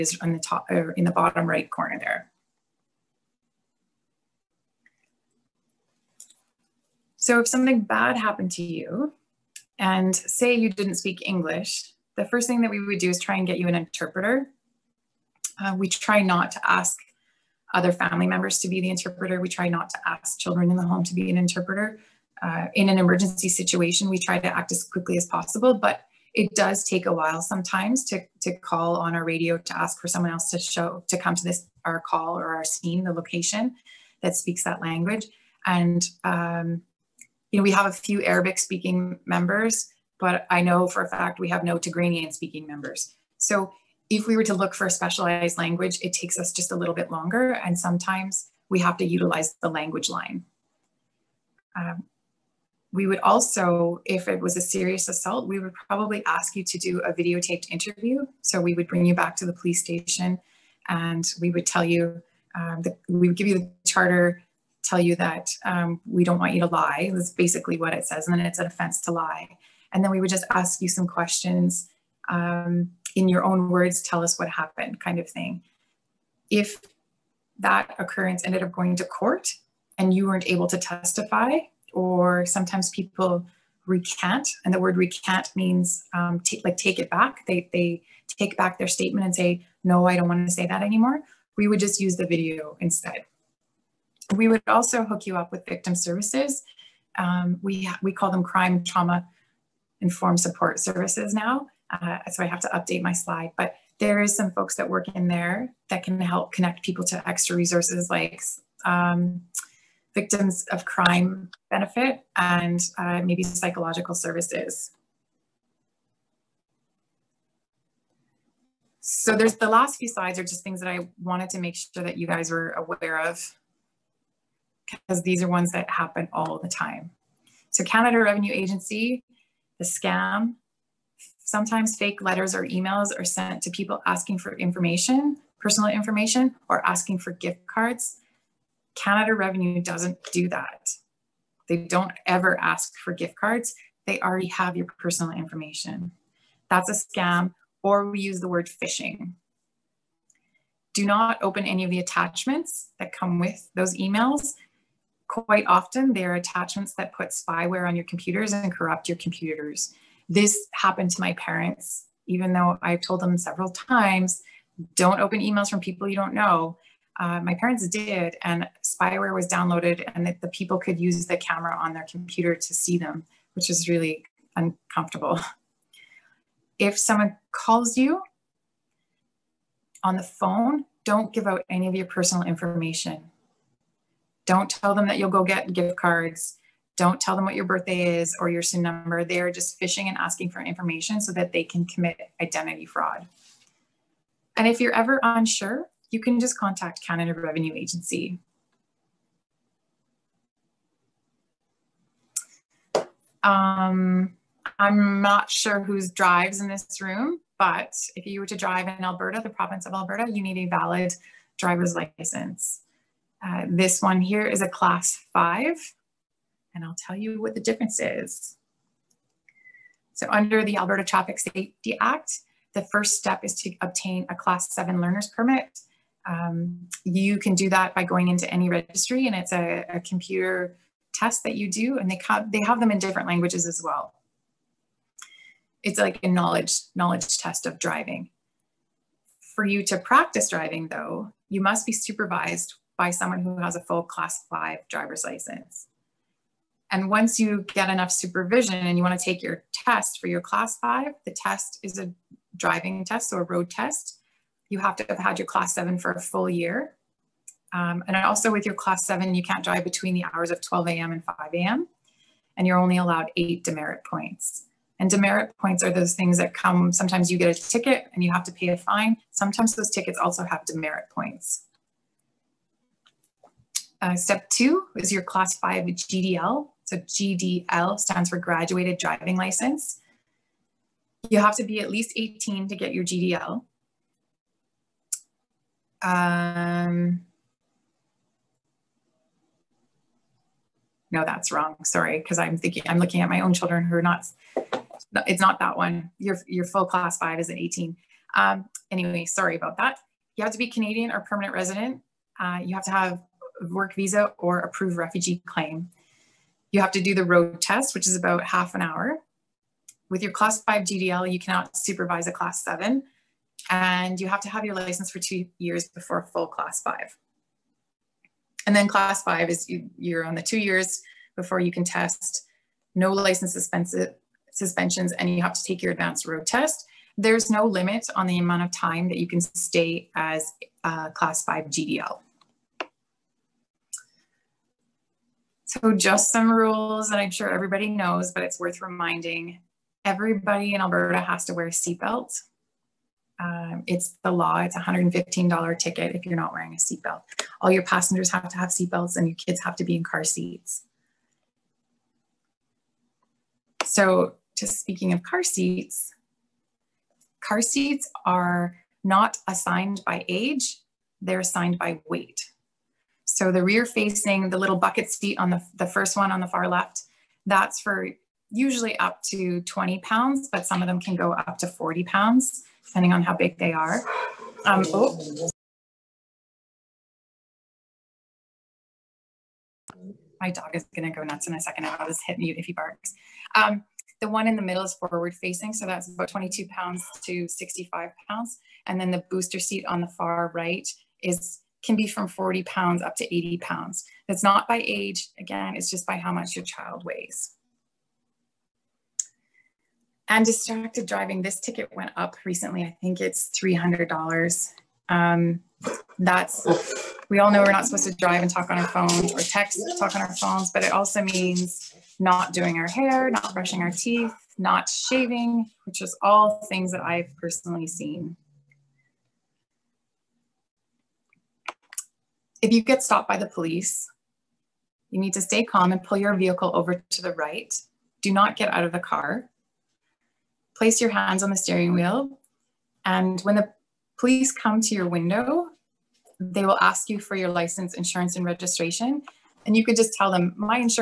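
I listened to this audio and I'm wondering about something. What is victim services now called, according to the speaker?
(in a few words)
crime trauma informed support services.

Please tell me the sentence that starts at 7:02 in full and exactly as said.
If you get stopped by the police, you need to stay calm and pull your vehicle over to the right.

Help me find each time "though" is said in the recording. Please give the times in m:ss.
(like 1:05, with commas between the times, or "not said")
2:42, 4:00.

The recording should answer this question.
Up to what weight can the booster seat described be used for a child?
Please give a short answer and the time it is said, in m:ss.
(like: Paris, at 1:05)
80 pounds, at 6:33.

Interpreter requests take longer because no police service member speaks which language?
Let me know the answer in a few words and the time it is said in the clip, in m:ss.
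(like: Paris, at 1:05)
Tigranian, at 0:41.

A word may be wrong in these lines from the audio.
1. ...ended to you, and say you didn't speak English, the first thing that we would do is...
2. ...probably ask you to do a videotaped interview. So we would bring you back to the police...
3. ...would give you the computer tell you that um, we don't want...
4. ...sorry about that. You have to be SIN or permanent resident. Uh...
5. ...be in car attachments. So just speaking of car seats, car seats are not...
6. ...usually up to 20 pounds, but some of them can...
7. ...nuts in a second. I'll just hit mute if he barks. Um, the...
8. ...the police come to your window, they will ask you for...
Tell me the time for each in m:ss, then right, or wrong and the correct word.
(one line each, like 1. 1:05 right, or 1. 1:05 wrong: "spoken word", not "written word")
1. 0:08 wrong: "happened", not "ended"
2. 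0:55 right
3. 1:03 wrong: "charter", not "computer"
4. 4:59 wrong: "Canadian", not "SIN"
5. 5:49 wrong: "seats", not "attachments"
6. 6:08 right
7. 6:21 right
8. 7:13 right.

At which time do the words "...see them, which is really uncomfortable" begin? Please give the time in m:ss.
2:52.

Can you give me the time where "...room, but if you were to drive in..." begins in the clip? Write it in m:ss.
3:27.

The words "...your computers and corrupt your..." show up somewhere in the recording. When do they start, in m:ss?
2:37.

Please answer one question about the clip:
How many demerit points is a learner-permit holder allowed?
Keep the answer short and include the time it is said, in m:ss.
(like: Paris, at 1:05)
8, at 4:23.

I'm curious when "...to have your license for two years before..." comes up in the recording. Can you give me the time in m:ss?
5:14.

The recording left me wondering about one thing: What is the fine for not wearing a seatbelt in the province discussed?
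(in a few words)
$115.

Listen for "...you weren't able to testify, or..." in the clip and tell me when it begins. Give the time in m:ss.
1:20.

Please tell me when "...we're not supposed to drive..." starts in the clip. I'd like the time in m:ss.
6:47.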